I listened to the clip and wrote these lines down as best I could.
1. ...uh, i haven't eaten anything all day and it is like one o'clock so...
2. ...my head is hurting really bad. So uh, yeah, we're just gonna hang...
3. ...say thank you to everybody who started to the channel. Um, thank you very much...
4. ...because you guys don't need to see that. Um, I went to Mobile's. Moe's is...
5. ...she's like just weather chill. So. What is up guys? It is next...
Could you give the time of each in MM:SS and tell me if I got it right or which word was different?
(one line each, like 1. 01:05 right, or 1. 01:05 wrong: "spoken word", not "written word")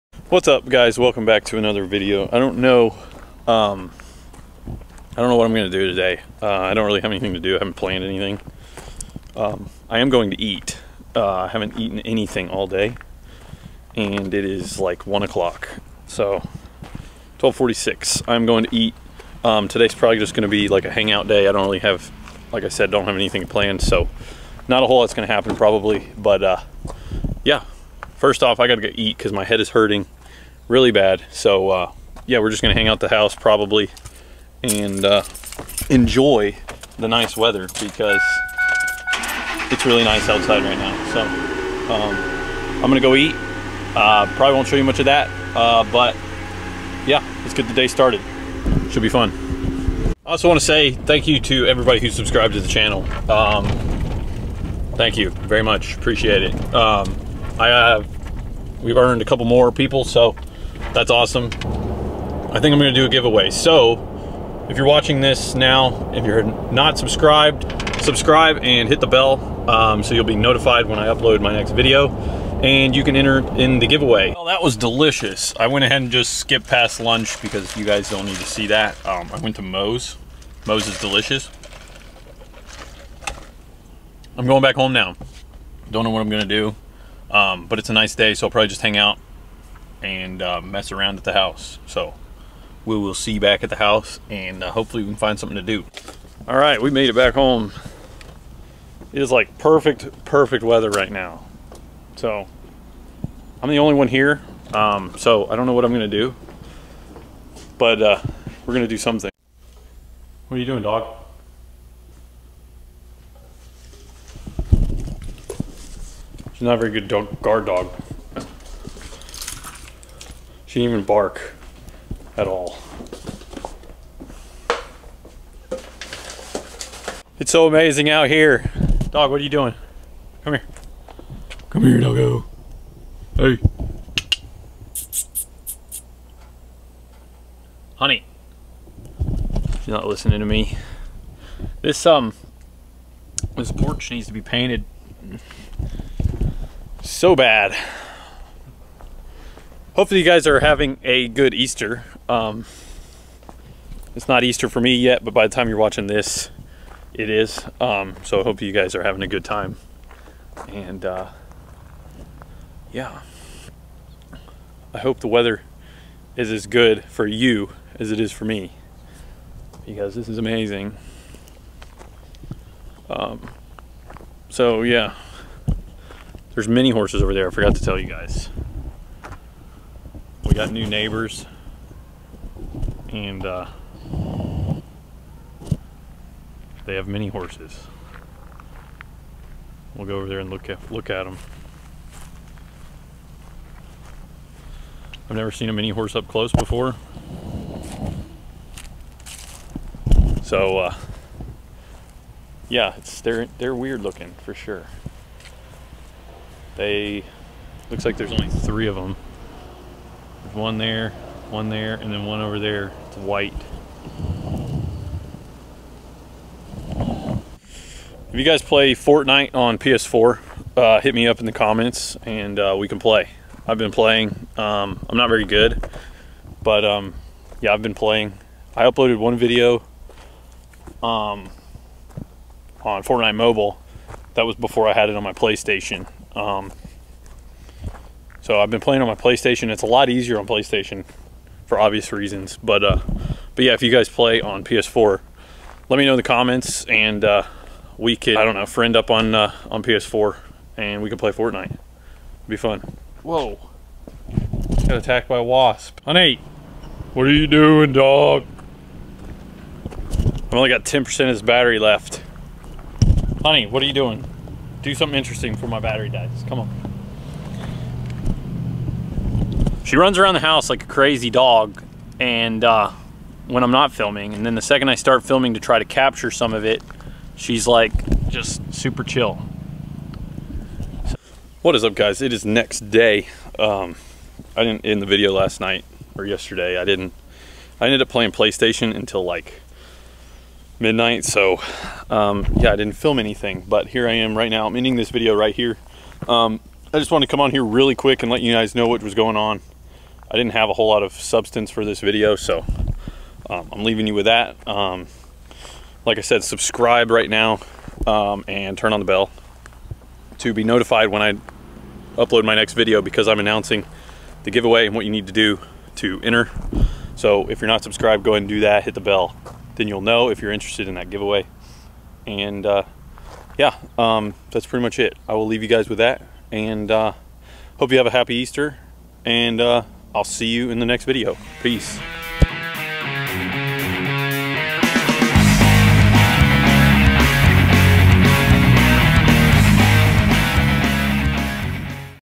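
1. 00:11 right
2. 00:29 right
3. 00:50 wrong: "subscribed", not "started"
4. 01:17 wrong: "Moe", not "Mobile"
5. 04:37 wrong: "super", not "weather".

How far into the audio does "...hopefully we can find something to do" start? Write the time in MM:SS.
01:34.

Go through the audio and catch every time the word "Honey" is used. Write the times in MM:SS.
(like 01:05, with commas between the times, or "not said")
02:17, 04:16, 04:23.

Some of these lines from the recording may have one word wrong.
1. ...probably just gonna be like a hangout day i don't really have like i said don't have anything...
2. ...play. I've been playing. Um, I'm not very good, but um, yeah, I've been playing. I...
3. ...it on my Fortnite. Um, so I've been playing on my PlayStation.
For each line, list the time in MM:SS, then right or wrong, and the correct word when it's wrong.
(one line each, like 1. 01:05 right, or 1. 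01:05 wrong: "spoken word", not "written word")
1. 00:19 right
2. 03:42 right
3. 03:55 wrong: "PlayStation", not "Fortnite".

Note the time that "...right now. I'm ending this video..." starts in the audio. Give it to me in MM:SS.
04:54.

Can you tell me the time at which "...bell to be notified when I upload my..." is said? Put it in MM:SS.
05:09.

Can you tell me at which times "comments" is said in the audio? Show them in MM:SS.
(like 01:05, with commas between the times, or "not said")
03:41, 04:06.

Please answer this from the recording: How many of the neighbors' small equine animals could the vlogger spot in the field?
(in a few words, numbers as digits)
3.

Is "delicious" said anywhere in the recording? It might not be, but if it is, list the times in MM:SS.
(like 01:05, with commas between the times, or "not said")
01:14, 01:20.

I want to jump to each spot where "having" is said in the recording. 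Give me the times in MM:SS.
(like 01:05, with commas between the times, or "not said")
02:30, 02:39.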